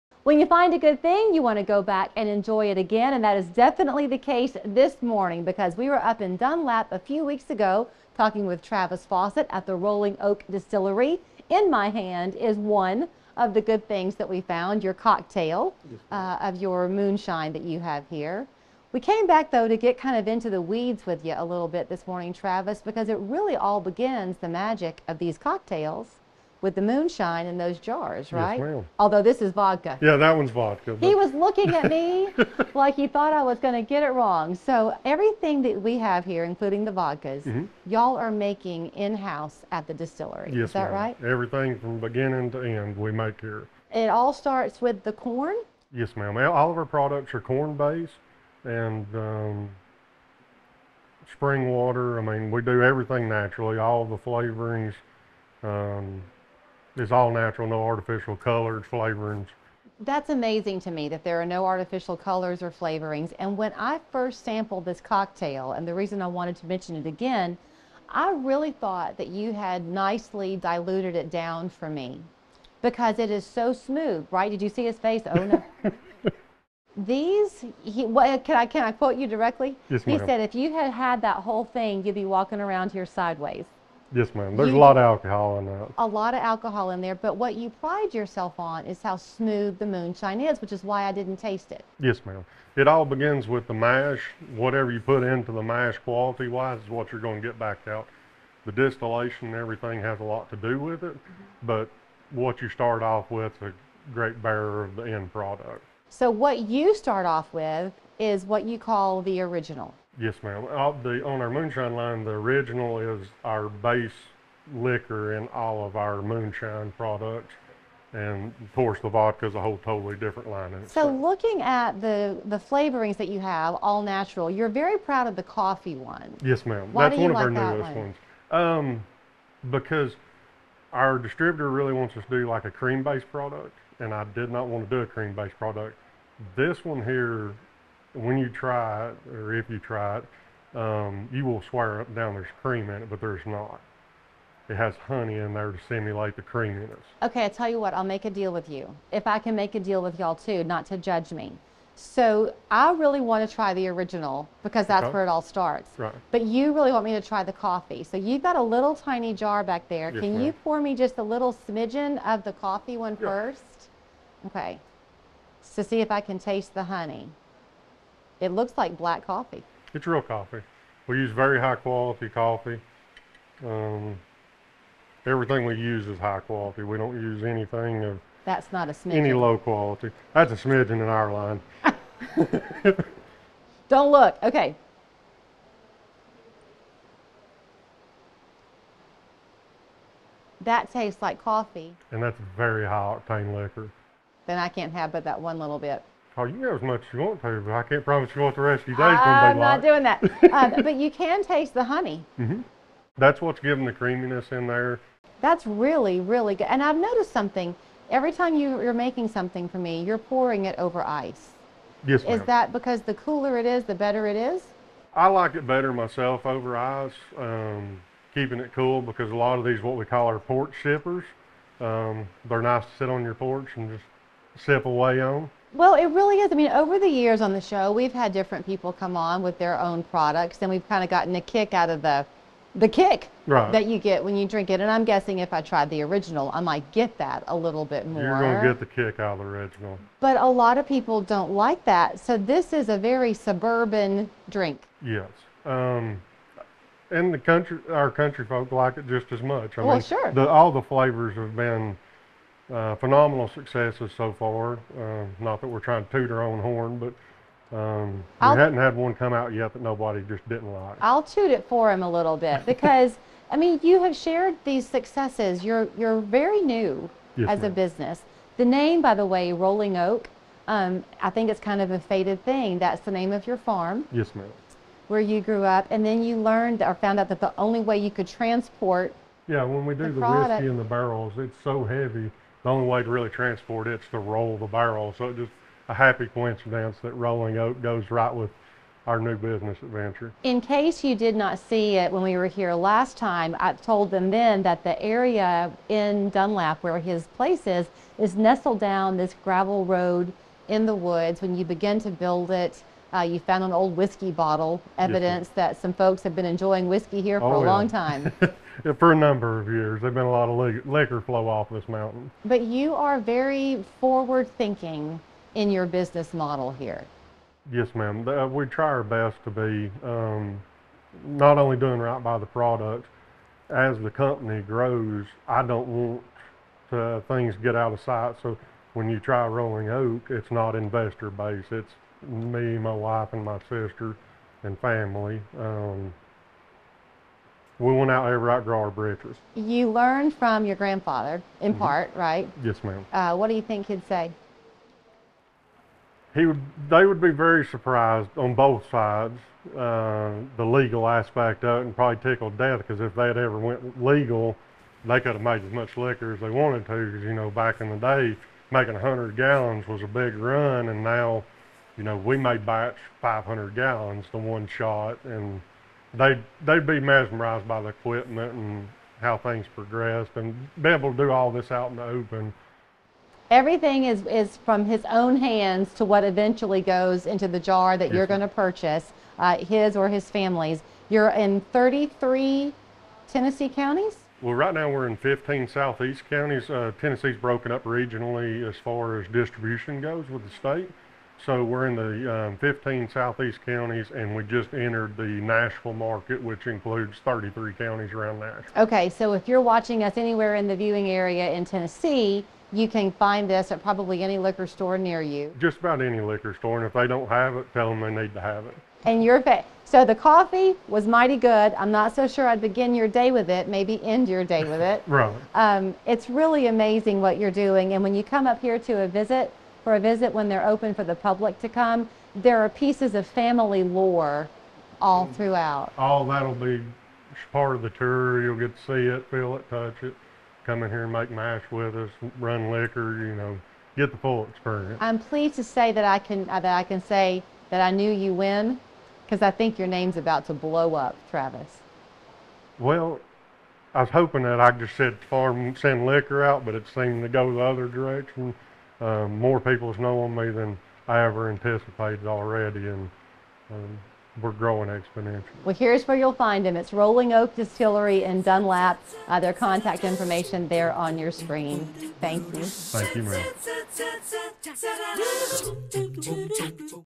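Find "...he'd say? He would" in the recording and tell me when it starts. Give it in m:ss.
5:43.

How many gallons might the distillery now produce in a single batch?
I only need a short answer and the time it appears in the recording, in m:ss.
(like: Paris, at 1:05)
500 gallons, at 6:03.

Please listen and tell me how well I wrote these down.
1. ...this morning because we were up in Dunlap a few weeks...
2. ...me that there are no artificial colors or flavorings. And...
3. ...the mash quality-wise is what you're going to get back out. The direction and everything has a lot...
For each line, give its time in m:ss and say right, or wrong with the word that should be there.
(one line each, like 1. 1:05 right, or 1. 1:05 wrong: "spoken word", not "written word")
1. 0:04 right
2. 1:00 right
3. 1:35 wrong: "distillation", not "direction".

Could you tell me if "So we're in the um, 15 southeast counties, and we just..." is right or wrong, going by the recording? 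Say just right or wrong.
right.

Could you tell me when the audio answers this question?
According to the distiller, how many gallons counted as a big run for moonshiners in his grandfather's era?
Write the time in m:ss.
5:58.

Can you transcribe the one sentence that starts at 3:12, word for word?
And that's very high octane liquor.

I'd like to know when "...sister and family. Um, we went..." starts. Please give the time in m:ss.
5:33.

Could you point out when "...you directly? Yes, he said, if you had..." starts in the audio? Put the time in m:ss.
1:19.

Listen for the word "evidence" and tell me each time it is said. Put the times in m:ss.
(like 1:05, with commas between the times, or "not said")
5:04.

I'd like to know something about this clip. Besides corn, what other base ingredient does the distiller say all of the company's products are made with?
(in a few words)
spring water.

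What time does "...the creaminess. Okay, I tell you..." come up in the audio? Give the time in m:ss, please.
2:26.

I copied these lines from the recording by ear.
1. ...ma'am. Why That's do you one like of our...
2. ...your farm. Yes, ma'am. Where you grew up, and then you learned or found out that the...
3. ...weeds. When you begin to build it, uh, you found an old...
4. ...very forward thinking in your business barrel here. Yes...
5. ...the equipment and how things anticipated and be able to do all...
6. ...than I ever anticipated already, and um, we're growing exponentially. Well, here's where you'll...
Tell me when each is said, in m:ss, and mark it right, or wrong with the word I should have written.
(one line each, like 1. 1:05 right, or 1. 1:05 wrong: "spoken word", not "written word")
1. 2:06 right
2. 4:33 right
3. 5:00 wrong: "woods", not "weeds"
4. 5:13 wrong: "model", not "barrel"
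5. 6:07 wrong: "progressed", not "anticipated"
6. 7:30 right.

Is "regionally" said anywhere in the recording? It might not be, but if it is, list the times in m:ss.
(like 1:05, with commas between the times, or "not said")
6:27.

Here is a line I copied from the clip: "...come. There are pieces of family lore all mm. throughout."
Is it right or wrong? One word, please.
right.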